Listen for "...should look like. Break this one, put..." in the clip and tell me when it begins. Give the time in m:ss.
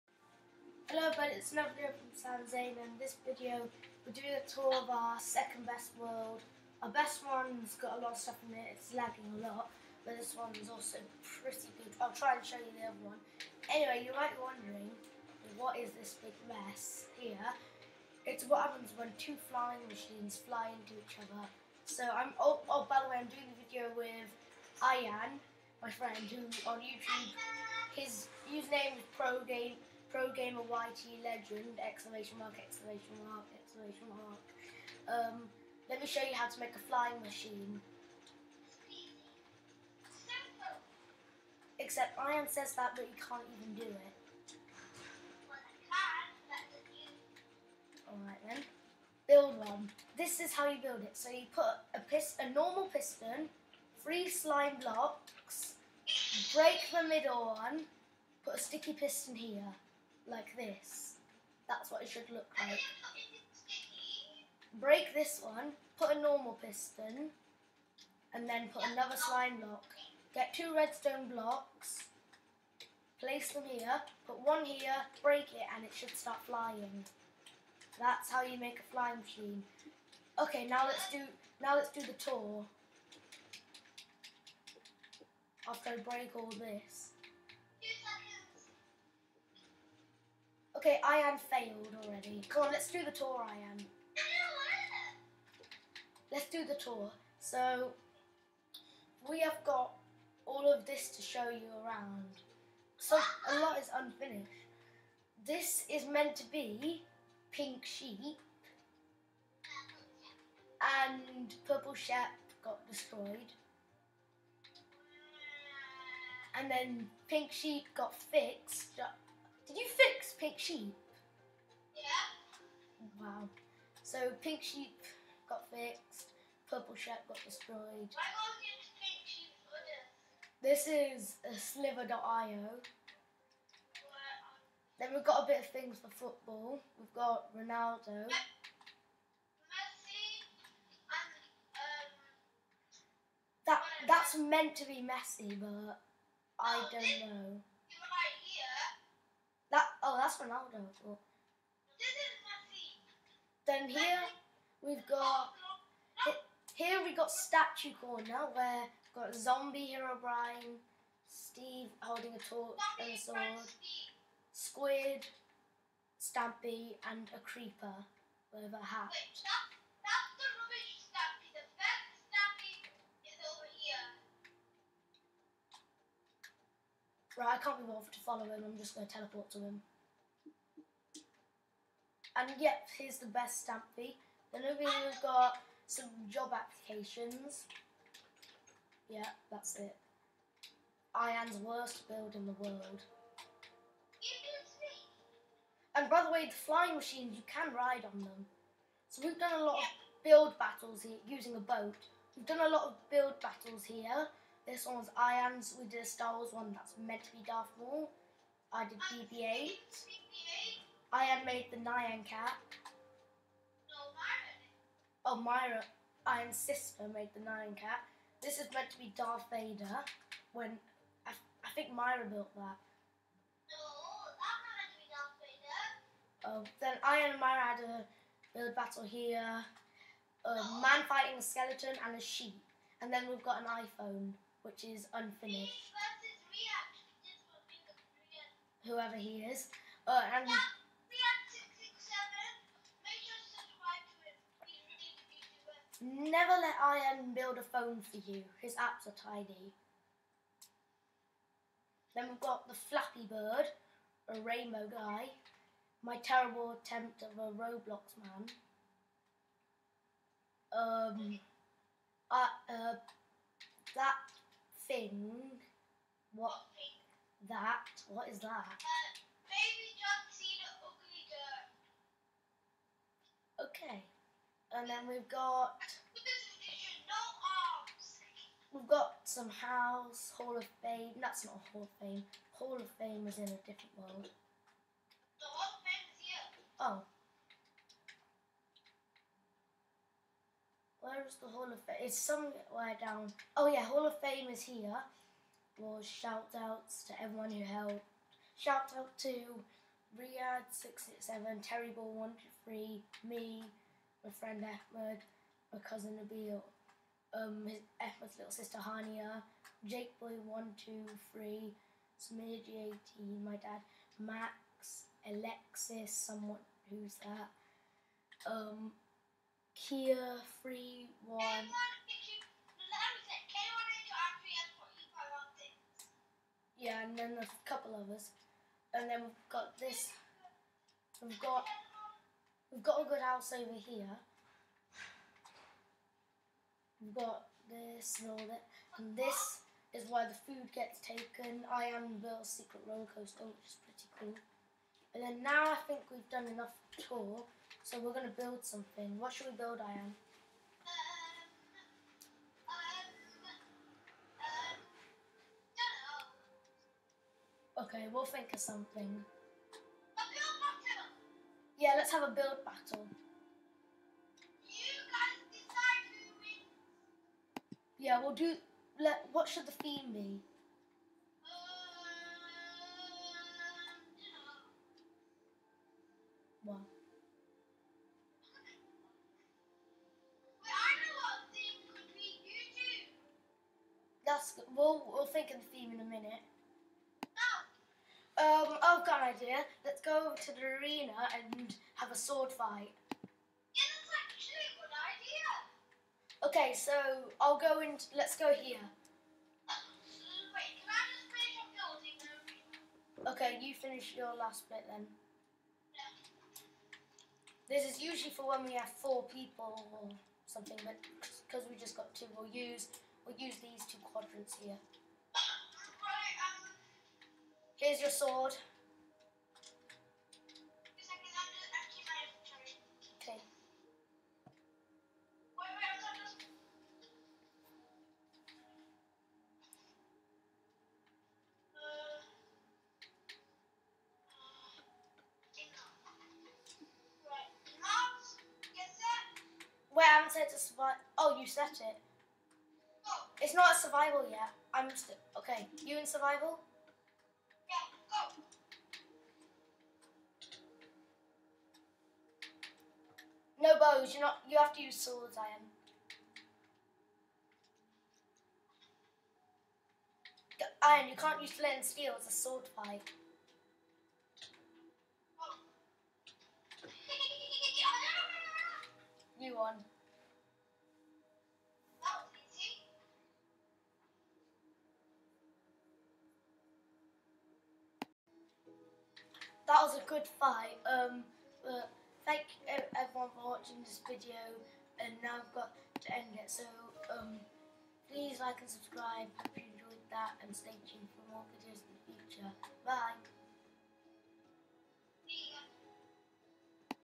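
1:02.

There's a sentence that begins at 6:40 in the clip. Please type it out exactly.
wait, can I just finish Okay, you finish your last bit then.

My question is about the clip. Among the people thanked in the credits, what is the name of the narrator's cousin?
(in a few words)
Nabil.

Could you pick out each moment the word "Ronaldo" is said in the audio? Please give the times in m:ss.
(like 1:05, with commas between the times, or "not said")
2:17, 2:30.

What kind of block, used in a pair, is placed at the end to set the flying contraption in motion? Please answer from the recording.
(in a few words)
Redstone blocks.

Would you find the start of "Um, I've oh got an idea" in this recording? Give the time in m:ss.
6:28.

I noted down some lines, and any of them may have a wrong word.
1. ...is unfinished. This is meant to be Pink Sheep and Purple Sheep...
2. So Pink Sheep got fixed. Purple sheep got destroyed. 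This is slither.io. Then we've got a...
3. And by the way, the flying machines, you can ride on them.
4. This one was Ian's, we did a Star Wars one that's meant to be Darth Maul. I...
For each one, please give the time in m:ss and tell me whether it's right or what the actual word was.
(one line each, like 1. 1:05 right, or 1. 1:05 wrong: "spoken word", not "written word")
1. 1:43 right
2. 2:04 right
3. 3:15 right
4. 3:24 right.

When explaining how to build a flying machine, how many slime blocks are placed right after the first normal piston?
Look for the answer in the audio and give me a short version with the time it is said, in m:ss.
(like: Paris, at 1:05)
3, at 0:54.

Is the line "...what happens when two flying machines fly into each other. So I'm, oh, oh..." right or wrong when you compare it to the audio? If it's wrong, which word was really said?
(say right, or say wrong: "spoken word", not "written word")
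right.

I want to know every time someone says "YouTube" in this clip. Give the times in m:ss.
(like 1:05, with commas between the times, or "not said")
0:26.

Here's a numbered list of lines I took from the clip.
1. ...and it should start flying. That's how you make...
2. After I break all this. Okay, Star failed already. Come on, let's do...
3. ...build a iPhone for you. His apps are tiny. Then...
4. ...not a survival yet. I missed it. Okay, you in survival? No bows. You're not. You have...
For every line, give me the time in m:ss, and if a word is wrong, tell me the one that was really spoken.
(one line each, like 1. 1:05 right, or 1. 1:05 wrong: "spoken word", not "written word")
1. 1:15 right
2. 1:25 wrong: "Ian", not "Star"
3. 4:07 wrong: "phone", not "iPhone"
4. 7:23 right.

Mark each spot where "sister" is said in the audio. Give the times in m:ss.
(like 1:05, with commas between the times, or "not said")
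3:36, 5:08.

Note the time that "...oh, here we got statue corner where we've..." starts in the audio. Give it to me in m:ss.
2:36.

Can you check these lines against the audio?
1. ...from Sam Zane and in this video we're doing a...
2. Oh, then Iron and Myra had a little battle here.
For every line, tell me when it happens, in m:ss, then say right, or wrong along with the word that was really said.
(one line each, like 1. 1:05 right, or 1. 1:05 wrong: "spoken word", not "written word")
1. 0:01 right
2. 3:46 right.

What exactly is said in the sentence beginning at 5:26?
Yeah, and then there's a couple of us, and then we've got this.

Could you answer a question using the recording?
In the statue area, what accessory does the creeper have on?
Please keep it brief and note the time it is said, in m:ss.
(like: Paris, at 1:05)
A hat, at 2:48.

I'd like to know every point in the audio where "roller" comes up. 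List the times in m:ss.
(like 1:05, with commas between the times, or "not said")
5:42.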